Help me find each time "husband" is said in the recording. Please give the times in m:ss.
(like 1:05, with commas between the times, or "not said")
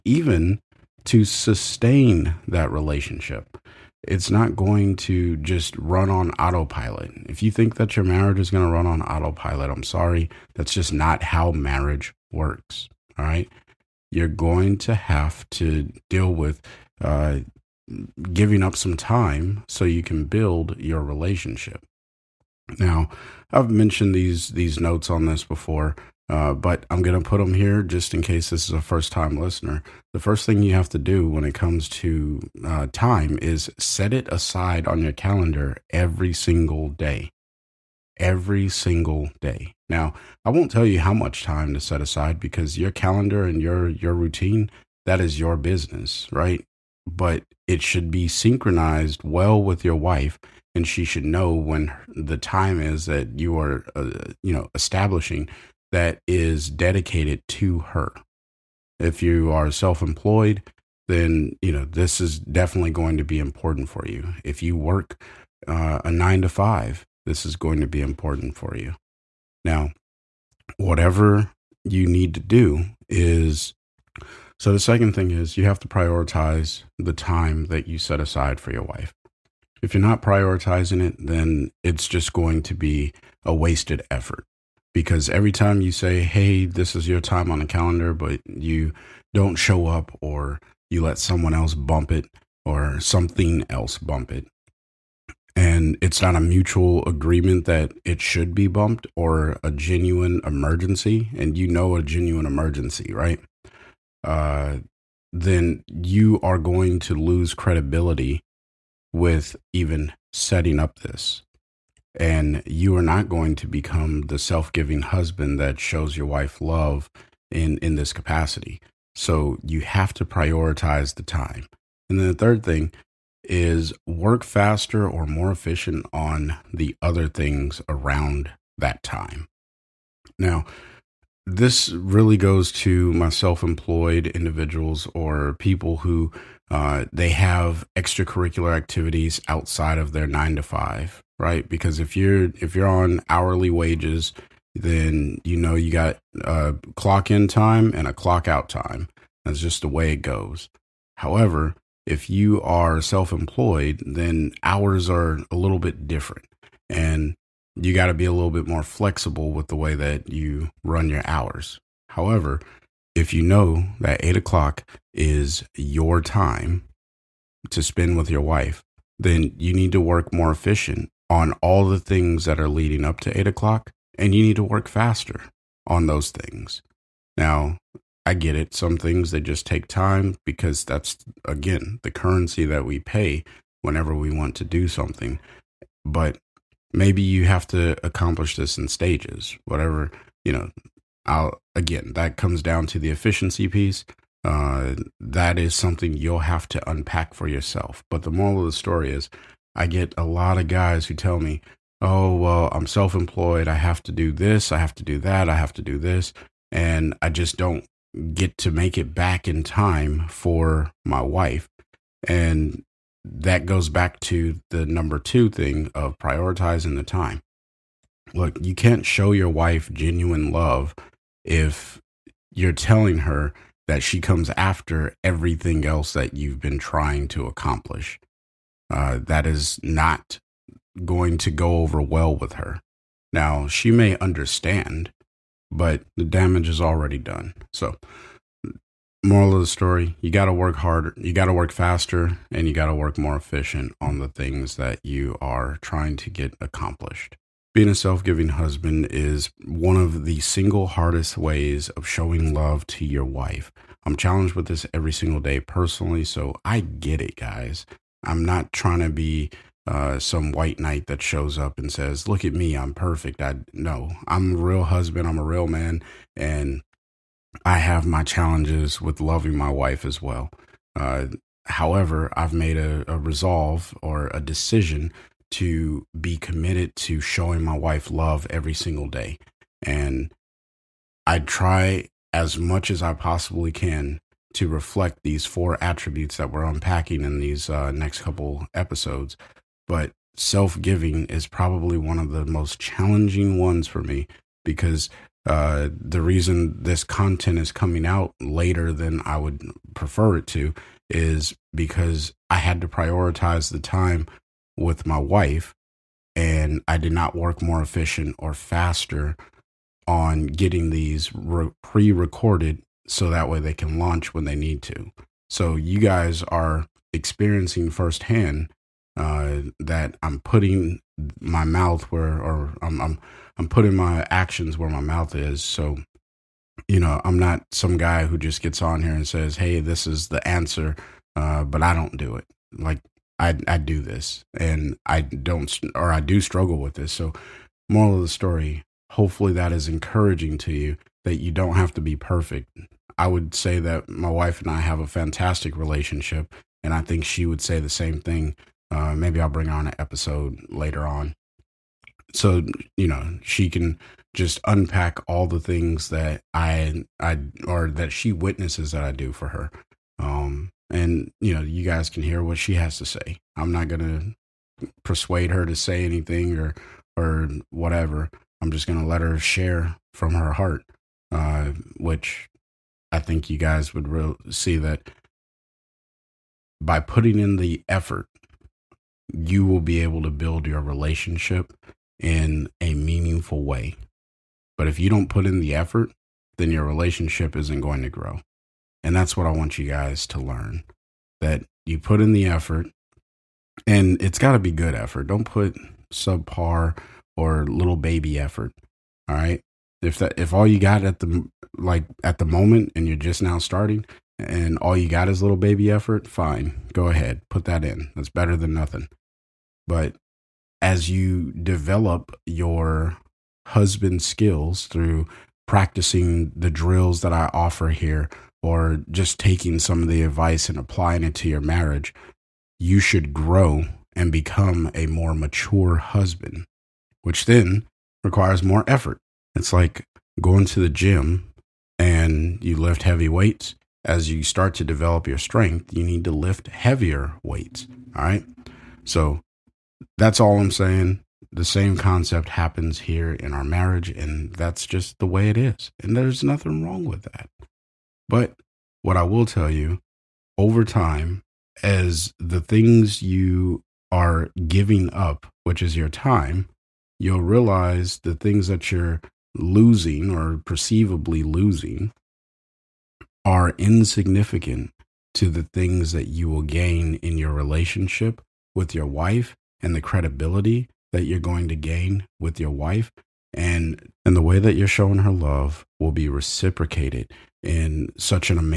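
1:55, 4:08, 4:24, 6:53, 7:05.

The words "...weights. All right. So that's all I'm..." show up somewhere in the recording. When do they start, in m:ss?
7:17.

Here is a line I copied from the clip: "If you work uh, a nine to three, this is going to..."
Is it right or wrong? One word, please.
wrong.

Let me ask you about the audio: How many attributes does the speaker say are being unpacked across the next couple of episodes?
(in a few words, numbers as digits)
4.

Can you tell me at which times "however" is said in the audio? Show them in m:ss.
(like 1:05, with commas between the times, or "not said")
2:31, 2:42, 4:31.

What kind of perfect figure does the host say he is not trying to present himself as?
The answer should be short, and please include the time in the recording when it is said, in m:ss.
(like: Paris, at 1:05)
White knight, at 4:20.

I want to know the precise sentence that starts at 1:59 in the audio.
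So you have to prioritize the time.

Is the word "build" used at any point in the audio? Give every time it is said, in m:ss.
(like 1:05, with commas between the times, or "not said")
0:20, 6:20.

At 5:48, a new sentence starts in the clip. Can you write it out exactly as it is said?
Uh, maybe I'll bring on an episode later on.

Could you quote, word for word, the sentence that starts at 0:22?
Now, I've mentioned these these notes on this before.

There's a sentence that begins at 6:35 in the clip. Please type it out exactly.
Don't put subpar or little baby effort.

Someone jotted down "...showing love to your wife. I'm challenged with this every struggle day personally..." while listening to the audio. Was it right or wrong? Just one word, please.
wrong.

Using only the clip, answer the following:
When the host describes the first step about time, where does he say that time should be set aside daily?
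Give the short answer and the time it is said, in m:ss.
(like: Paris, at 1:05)
On your calendar, at 0:34.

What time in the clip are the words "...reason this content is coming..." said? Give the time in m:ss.
4:56.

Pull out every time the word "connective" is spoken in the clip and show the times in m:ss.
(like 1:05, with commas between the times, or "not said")
not said.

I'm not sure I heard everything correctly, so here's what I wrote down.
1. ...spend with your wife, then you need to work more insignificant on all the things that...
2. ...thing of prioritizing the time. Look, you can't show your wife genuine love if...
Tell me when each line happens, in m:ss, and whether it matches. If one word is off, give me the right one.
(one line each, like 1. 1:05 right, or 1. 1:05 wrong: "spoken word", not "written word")
1. 2:47 wrong: "efficient", not "insignificant"
2. 3:35 right.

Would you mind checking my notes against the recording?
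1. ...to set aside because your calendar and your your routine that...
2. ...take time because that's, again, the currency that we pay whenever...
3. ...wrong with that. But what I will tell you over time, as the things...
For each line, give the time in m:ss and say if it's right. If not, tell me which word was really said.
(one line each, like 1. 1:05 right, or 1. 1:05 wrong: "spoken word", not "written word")
1. 0:41 right
2. 2:59 right
3. 7:26 right.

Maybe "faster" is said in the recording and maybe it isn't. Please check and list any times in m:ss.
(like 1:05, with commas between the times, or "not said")
2:04, 2:54, 4:01, 5:08.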